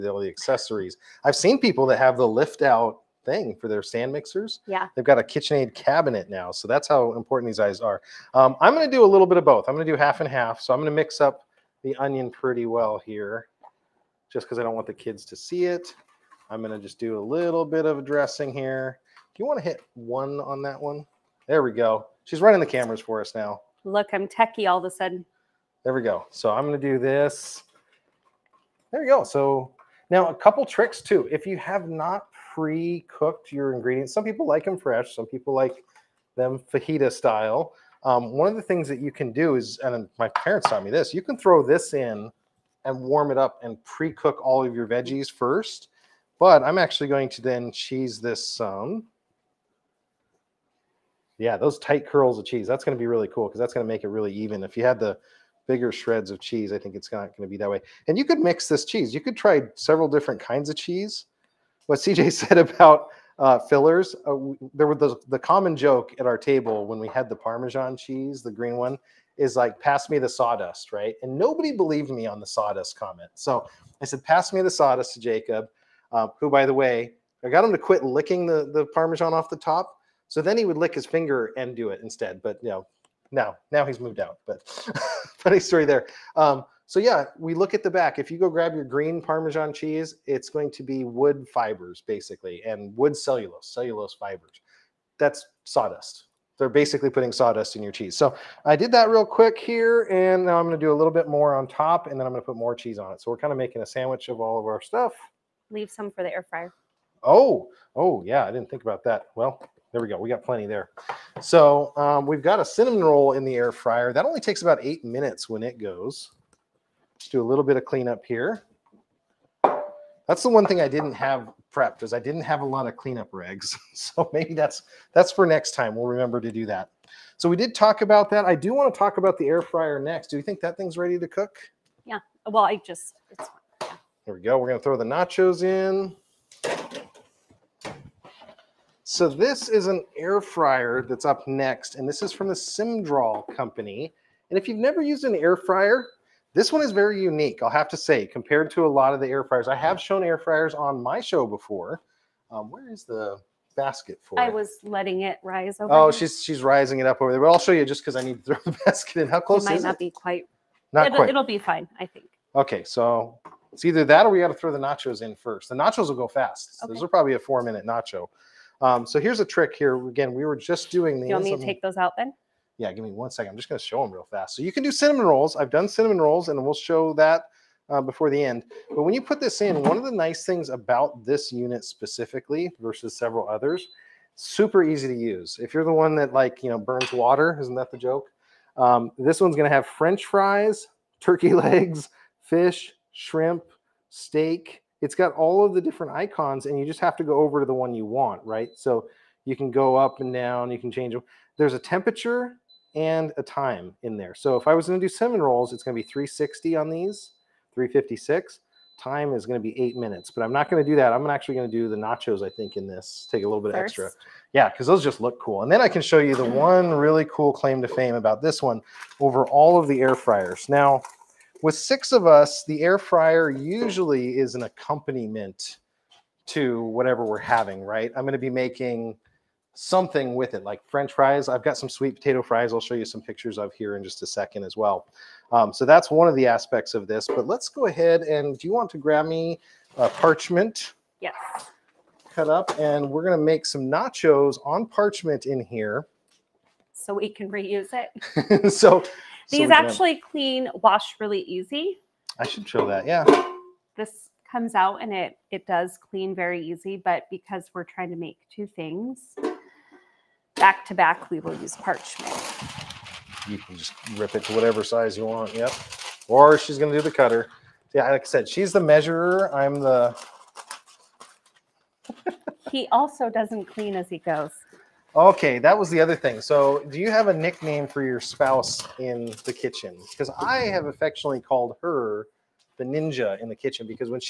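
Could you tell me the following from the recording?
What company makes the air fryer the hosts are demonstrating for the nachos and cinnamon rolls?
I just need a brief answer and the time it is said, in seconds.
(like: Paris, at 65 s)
Symdral, at 142 s.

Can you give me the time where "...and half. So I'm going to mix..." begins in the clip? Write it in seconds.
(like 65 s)
10 s.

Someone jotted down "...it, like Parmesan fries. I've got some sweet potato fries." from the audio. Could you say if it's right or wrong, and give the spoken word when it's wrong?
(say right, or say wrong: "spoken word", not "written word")
wrong: "French", not "Parmesan".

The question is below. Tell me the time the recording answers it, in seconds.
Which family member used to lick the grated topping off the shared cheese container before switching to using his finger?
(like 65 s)
75 s.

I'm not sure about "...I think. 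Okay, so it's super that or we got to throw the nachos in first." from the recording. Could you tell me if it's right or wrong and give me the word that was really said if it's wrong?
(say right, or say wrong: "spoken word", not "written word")
wrong: "either", not "super".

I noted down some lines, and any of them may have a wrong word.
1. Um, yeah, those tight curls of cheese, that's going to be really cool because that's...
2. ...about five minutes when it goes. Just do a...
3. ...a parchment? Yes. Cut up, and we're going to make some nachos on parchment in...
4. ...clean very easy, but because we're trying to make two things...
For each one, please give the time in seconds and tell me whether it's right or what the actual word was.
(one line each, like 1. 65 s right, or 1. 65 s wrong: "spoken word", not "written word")
1. 48 s right
2. 114 s wrong: "eight", not "five"
3. 239 s right
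4. 256 s right.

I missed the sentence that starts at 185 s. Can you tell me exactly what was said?
If you're the one that like, you know, burns water, isn't that the joke?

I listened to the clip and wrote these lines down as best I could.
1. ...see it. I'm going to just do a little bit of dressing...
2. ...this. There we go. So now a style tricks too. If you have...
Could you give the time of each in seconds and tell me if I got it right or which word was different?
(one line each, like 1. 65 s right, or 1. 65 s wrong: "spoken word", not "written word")
1. 15 s right
2. 26 s wrong: "couple", not "style".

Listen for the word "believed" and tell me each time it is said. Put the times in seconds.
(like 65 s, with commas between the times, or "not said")
71 s.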